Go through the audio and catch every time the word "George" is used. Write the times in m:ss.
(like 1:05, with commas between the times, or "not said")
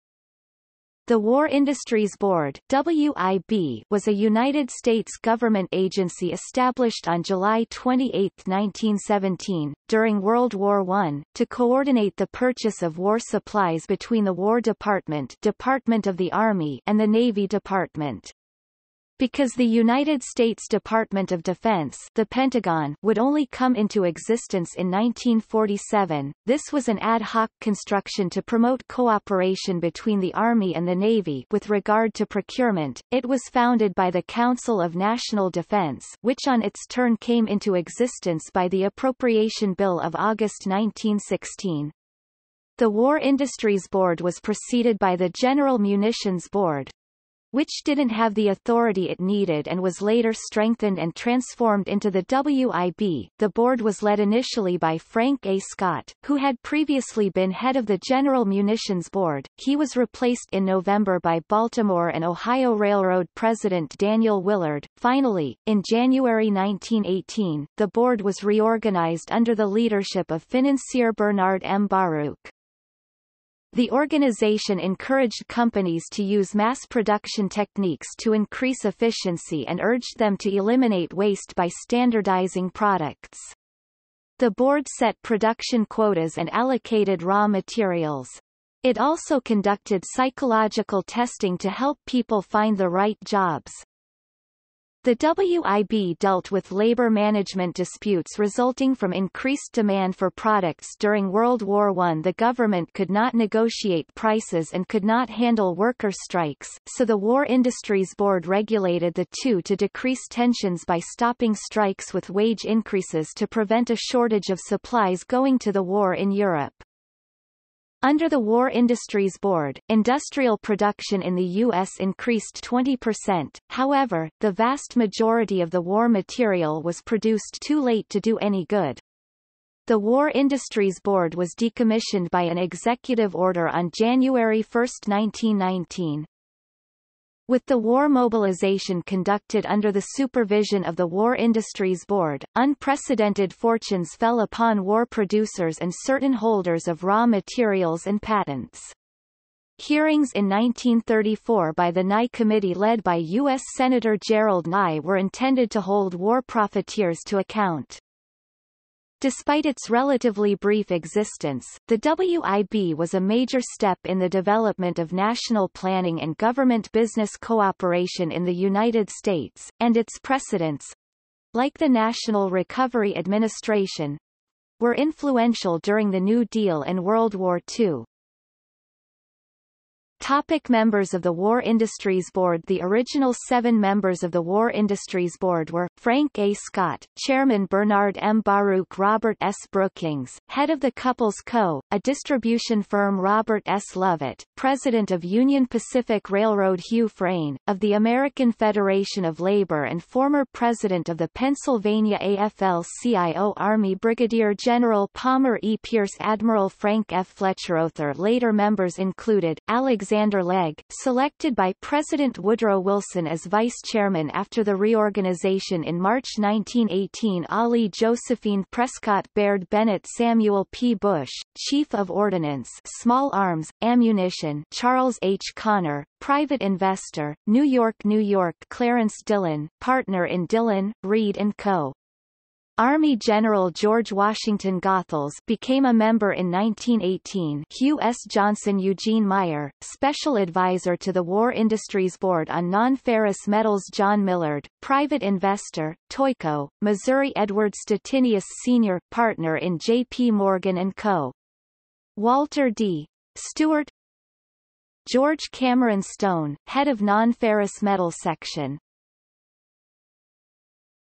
3:53, 4:15.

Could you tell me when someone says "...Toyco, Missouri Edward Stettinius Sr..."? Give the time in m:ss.
4:06.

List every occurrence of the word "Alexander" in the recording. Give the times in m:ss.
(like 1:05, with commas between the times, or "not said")
3:29.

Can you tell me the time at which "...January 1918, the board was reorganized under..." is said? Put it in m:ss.
1:05.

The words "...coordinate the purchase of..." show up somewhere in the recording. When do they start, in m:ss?
0:11.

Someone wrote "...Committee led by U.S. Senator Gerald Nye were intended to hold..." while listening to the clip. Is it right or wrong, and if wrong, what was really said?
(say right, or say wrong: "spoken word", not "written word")
right.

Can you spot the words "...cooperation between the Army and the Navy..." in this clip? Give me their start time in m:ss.
0:28.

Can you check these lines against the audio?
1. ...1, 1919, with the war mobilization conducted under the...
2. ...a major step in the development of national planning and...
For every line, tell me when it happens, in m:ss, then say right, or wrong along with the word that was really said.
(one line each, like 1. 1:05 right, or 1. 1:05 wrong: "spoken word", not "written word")
1. 2:14 right
2. 2:43 right.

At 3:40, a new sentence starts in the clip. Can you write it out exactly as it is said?
Bush, Chief of Ordnance Small Arms, Ammunition Charles H.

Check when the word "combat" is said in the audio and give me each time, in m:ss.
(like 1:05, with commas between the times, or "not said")
not said.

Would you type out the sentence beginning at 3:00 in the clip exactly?
Topic members of the War Industries Board The original seven members of the War Industries Board were, Frank A.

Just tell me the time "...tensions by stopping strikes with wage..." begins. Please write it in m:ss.
1:50.